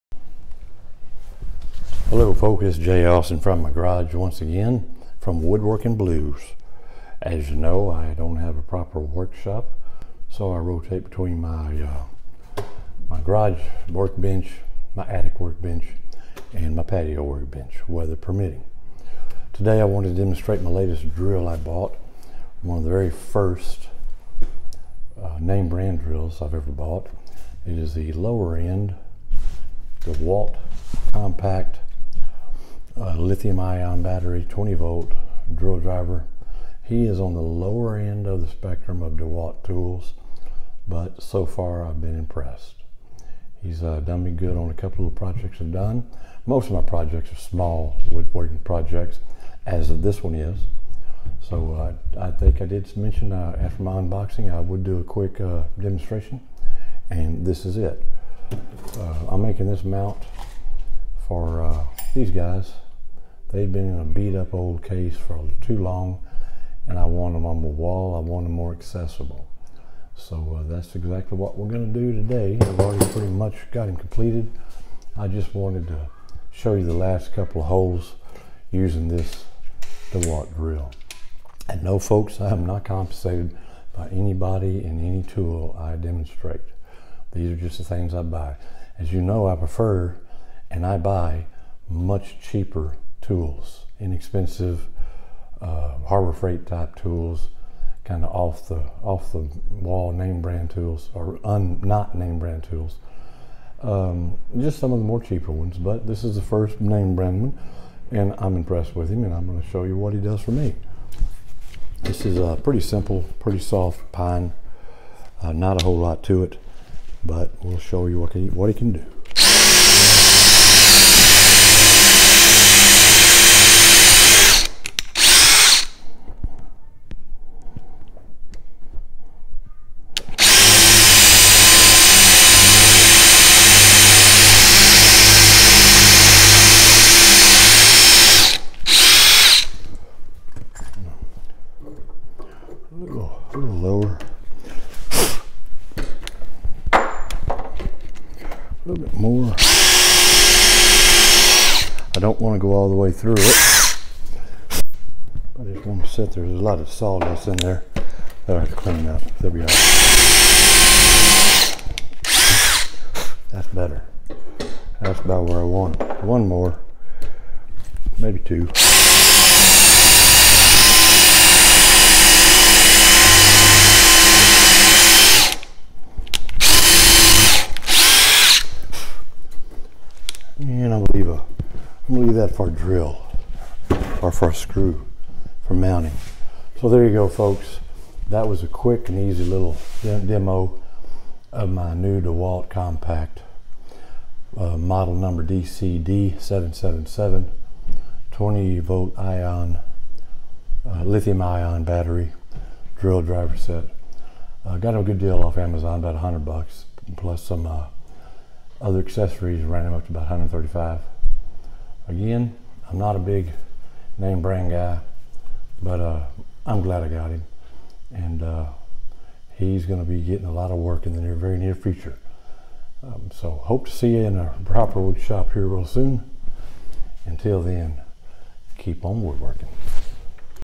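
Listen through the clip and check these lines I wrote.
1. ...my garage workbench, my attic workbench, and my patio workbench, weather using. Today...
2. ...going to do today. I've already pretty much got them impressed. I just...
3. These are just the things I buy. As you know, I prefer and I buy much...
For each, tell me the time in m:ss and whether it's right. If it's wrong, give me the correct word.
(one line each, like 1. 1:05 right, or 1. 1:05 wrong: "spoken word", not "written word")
1. 0:13 wrong: "permitting", not "using"
2. 1:11 wrong: "completed", not "impressed"
3. 1:27 right.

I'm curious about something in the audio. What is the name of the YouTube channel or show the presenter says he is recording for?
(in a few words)
Woodworking Blues.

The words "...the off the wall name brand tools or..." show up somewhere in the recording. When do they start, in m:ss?
1:38.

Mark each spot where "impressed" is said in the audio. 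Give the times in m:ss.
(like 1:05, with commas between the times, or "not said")
0:42, 1:48.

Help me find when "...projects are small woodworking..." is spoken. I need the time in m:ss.
0:46.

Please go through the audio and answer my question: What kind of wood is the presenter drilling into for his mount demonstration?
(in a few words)
pine.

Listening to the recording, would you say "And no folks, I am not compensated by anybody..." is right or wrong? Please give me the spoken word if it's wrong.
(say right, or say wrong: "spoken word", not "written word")
right.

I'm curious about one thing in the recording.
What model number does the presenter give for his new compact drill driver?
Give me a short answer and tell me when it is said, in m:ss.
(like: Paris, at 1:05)
DCD777, at 3:15.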